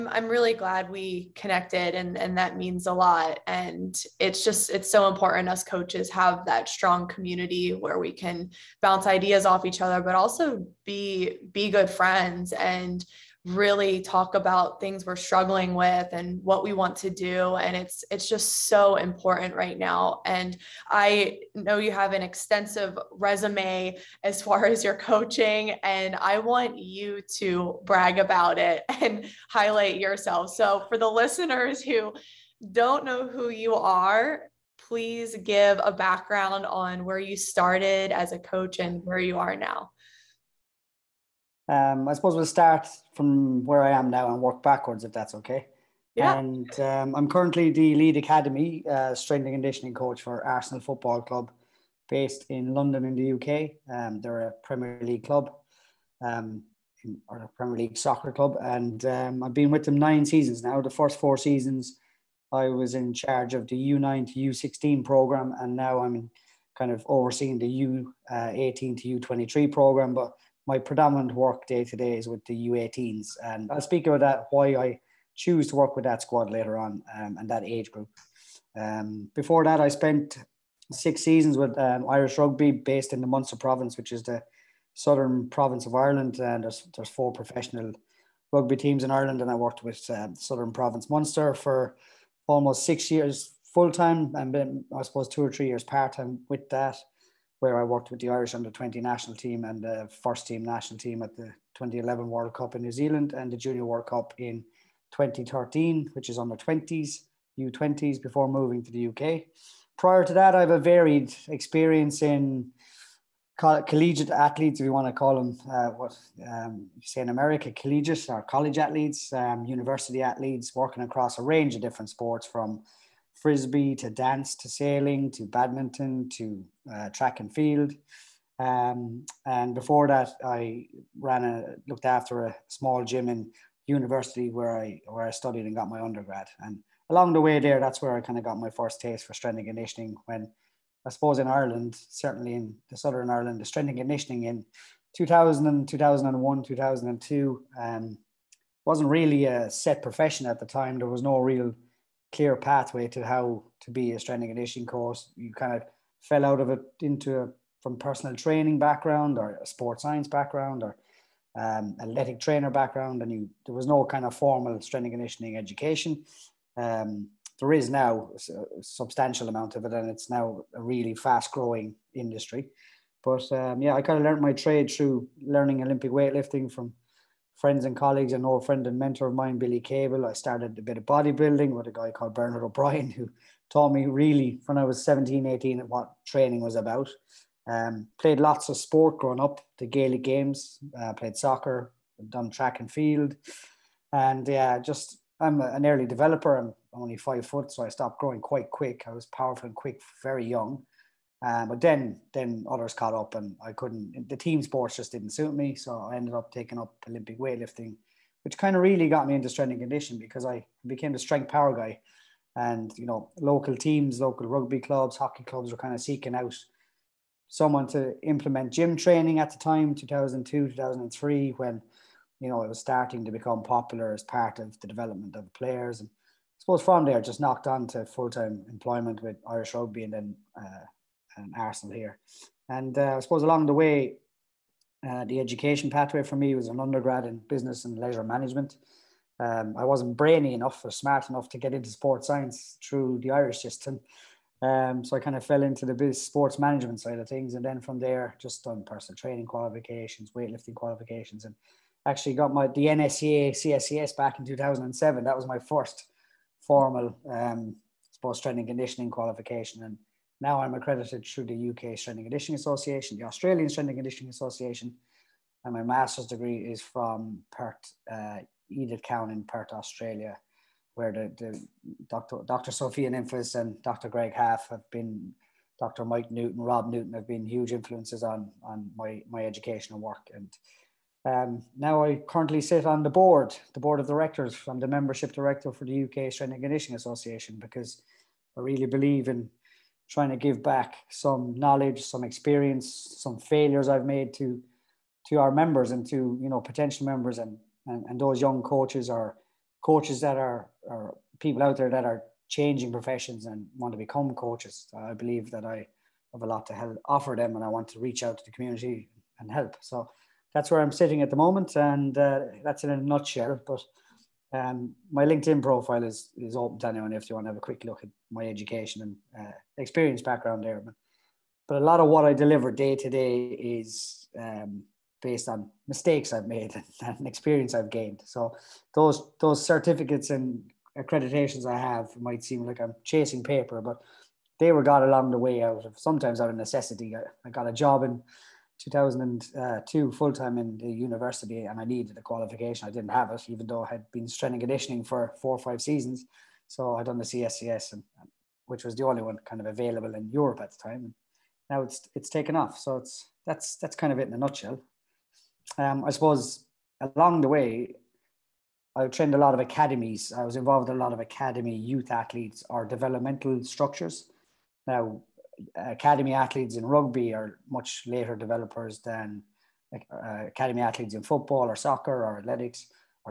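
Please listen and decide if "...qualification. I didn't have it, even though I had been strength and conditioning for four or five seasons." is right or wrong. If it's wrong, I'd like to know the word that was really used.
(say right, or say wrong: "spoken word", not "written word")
right.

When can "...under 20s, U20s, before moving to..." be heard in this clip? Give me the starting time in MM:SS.
01:46.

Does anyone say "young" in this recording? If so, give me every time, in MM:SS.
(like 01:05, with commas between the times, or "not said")
03:20, 04:58.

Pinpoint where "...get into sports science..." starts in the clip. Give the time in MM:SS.
04:01.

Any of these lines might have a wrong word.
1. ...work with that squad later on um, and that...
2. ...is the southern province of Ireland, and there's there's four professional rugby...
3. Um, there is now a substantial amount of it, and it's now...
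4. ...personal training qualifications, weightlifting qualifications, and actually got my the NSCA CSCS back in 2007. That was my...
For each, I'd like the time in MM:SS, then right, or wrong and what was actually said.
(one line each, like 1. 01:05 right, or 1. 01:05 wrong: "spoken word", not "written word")
1. 01:15 right
2. 01:24 right
3. 02:46 right
4. 04:08 right.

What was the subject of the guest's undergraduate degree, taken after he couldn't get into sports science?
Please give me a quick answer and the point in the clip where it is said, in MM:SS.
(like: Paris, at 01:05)
Business and leisure management, at 03:57.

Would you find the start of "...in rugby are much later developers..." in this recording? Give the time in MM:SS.
06:06.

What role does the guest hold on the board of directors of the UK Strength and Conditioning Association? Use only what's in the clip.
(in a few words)
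Membership director.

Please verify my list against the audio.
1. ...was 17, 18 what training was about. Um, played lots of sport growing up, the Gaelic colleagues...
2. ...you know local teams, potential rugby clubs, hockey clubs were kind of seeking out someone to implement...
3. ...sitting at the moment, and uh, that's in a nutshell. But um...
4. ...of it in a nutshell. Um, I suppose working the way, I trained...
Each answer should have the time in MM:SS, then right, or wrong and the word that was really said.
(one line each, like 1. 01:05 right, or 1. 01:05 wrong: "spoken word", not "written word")
1. 03:04 wrong: "games", not "colleagues"
2. 03:32 wrong: "local", not "potential"
3. 05:10 right
4. 05:54 wrong: "along", not "working".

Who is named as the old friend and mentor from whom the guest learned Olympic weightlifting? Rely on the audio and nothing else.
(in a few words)
Billy Cable.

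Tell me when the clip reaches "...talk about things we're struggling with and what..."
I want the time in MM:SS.
00:14.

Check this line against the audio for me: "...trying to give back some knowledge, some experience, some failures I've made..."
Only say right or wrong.
right.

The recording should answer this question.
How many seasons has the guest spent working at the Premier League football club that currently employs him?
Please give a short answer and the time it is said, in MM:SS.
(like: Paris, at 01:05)
9, at 00:59.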